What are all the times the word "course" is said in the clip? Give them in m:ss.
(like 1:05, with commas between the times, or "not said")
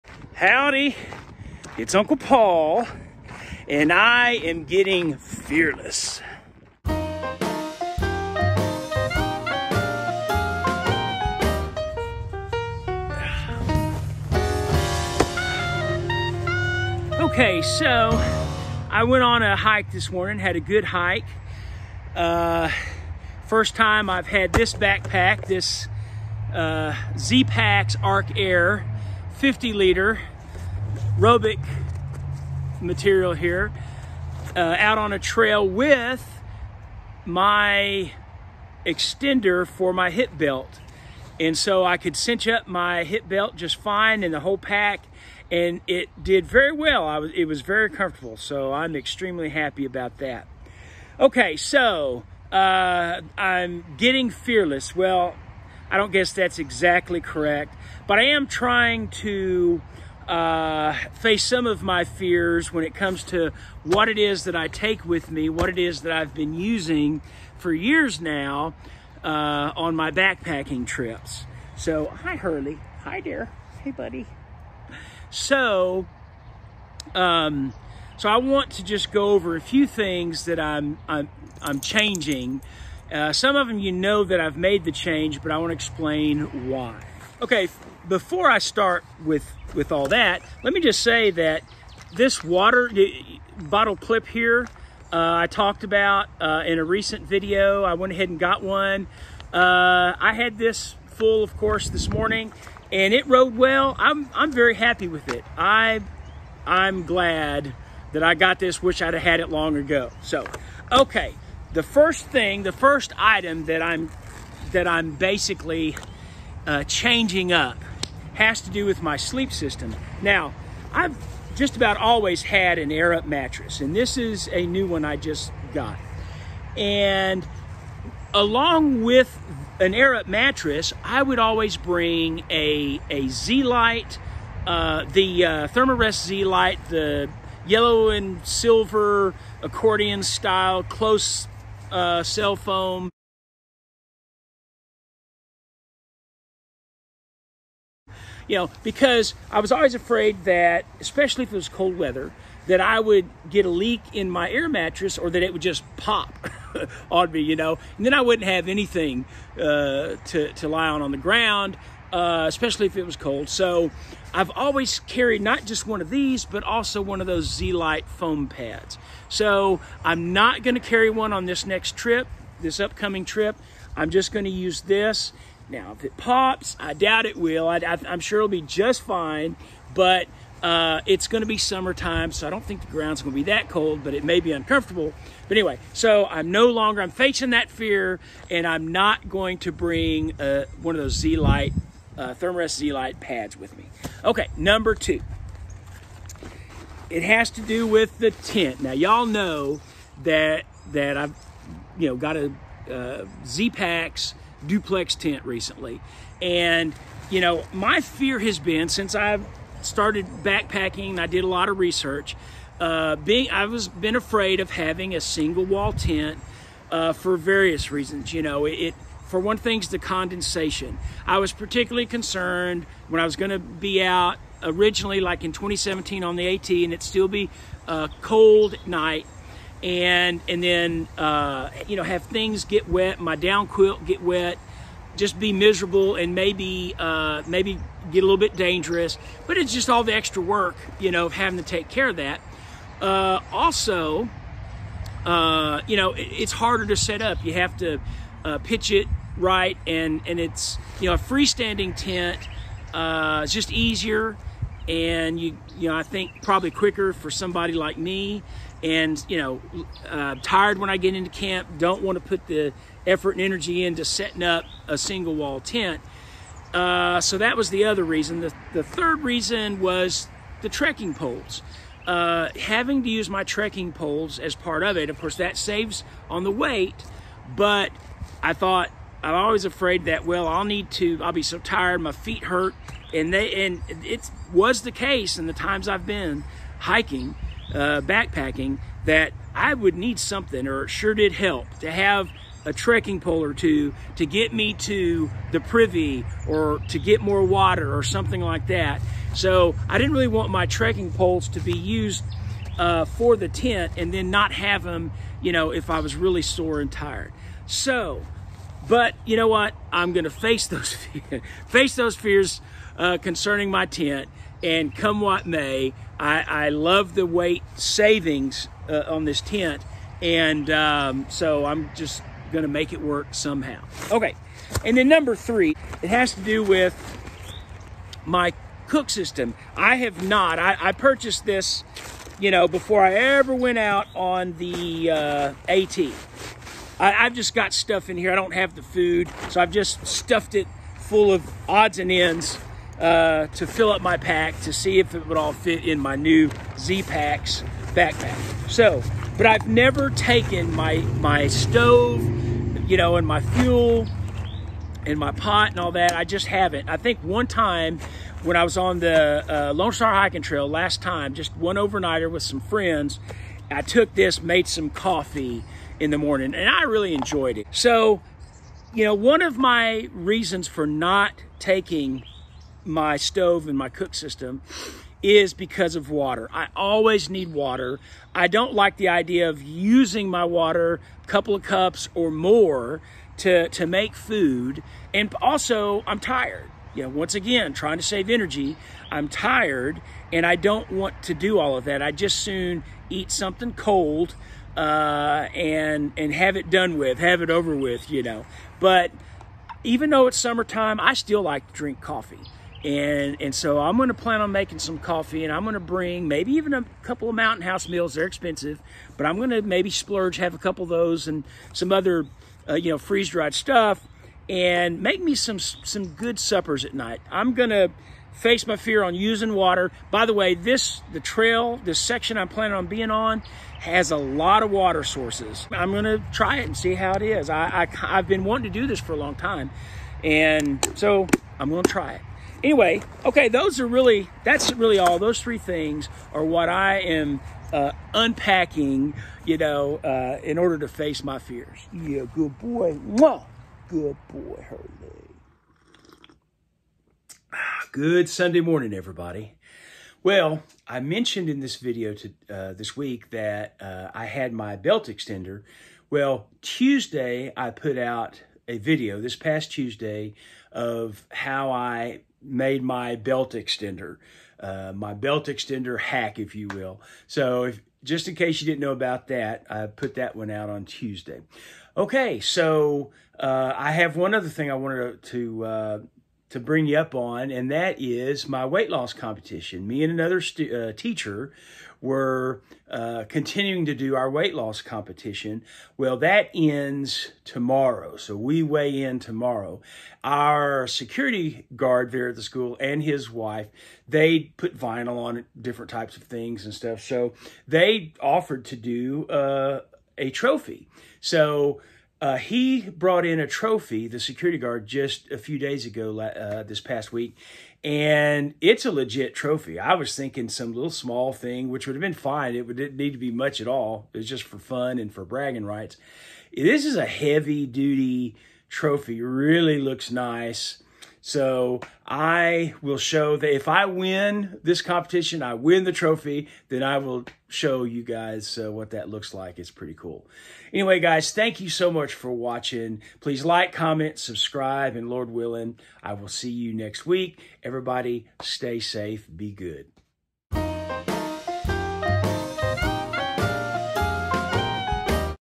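1:41, 4:35.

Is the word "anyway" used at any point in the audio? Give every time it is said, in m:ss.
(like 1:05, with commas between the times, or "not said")
3:05, 7:12, 8:50.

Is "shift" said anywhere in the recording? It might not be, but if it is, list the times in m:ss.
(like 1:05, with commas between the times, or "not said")
not said.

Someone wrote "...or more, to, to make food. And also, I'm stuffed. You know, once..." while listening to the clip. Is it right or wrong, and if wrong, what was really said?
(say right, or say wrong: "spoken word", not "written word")
wrong: "tired", not "stuffed".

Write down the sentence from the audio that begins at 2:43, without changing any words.
So I've always carried not just one of these, but also one of those Z Lite foam pads.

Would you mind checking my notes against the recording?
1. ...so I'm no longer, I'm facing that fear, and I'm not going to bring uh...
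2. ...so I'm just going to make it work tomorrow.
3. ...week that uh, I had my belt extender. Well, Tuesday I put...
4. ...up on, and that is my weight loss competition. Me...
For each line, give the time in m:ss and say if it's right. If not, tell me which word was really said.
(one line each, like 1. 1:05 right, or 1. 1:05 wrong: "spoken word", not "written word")
1. 3:05 right
2. 5:21 wrong: "somehow", not "tomorrow"
3. 7:32 right
4. 7:56 right.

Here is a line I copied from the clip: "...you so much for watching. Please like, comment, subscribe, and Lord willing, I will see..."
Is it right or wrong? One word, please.
right.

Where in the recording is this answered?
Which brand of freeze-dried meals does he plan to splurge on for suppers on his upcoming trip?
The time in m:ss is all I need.
6:47.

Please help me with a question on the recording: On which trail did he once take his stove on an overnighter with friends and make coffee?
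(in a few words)
Lone Star Hiking Trail.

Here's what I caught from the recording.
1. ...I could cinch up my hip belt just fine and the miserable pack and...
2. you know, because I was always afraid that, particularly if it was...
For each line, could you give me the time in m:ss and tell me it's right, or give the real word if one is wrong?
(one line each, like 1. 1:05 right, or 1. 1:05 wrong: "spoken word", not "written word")
1. 0:41 wrong: "whole", not "miserable"
2. 2:28 wrong: "especially", not "particularly".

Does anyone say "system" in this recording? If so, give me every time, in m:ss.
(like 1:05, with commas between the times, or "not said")
1:59, 5:29, 6:14.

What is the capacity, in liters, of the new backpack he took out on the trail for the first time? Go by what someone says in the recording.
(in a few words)
50.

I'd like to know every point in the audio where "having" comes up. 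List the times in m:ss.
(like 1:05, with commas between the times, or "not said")
3:34, 4:01, 4:32.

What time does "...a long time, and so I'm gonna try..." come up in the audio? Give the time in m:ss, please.
7:09.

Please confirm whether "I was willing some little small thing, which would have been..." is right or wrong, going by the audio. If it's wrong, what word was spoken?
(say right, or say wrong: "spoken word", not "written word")
wrong: "thinking", not "willing".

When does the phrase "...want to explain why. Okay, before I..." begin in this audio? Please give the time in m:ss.
1:25.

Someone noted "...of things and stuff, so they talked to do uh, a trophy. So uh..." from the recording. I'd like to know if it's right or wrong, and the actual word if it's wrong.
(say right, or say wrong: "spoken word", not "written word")
wrong: "offered", not "talked".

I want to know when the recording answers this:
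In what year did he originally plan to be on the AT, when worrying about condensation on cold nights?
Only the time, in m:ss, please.
3:45.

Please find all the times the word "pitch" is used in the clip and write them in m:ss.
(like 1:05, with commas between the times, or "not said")
4:08.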